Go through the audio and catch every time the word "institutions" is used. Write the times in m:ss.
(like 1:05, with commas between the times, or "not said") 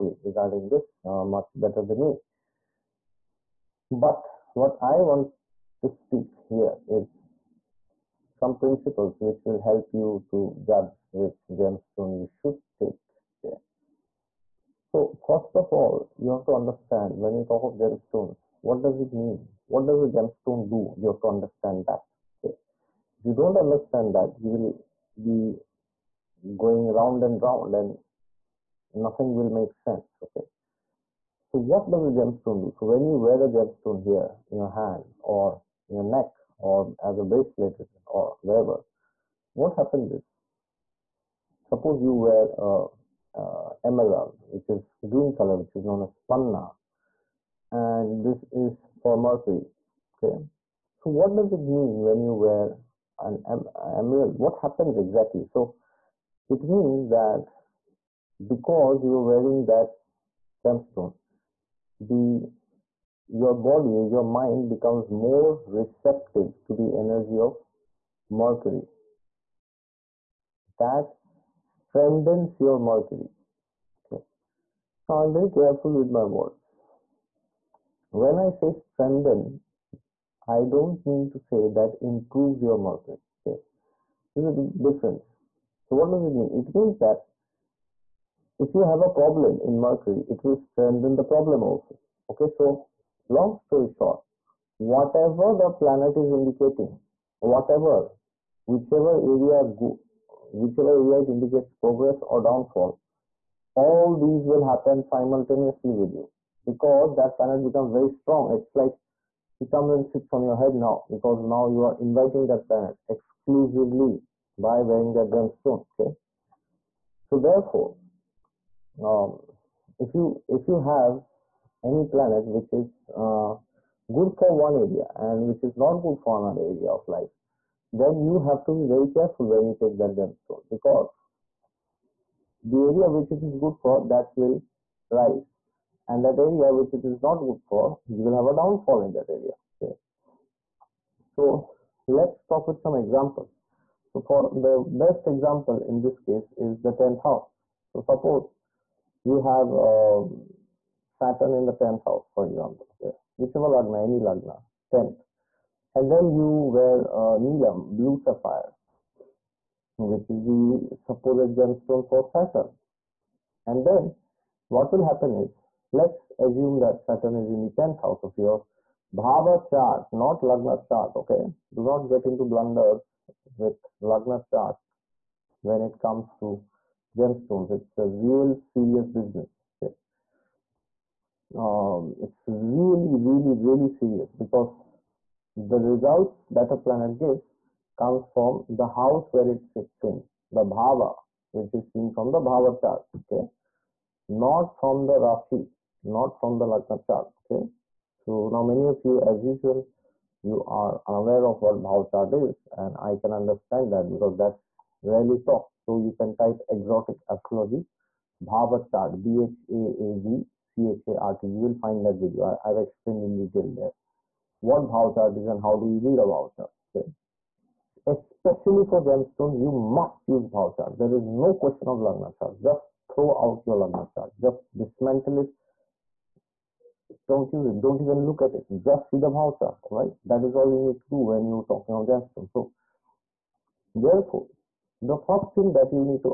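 not said.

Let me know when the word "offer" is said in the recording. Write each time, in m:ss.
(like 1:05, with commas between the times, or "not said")
not said.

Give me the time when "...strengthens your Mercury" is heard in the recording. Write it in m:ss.
1:11.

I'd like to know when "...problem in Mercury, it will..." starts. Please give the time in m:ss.
1:29.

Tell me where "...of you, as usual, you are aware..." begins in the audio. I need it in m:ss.
3:18.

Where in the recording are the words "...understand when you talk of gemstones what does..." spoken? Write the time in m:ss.
0:16.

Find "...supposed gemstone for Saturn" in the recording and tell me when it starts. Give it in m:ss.
2:40.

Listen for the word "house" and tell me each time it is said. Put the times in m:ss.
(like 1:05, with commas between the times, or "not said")
2:27, 2:32, 2:48, 3:08.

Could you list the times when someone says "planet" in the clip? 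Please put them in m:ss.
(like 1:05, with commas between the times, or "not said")
1:35, 1:47, 1:52, 2:02, 3:06.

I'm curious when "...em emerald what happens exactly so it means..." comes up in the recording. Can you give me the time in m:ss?
0:53.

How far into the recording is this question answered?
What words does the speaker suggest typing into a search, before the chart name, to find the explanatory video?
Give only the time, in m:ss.
3:26.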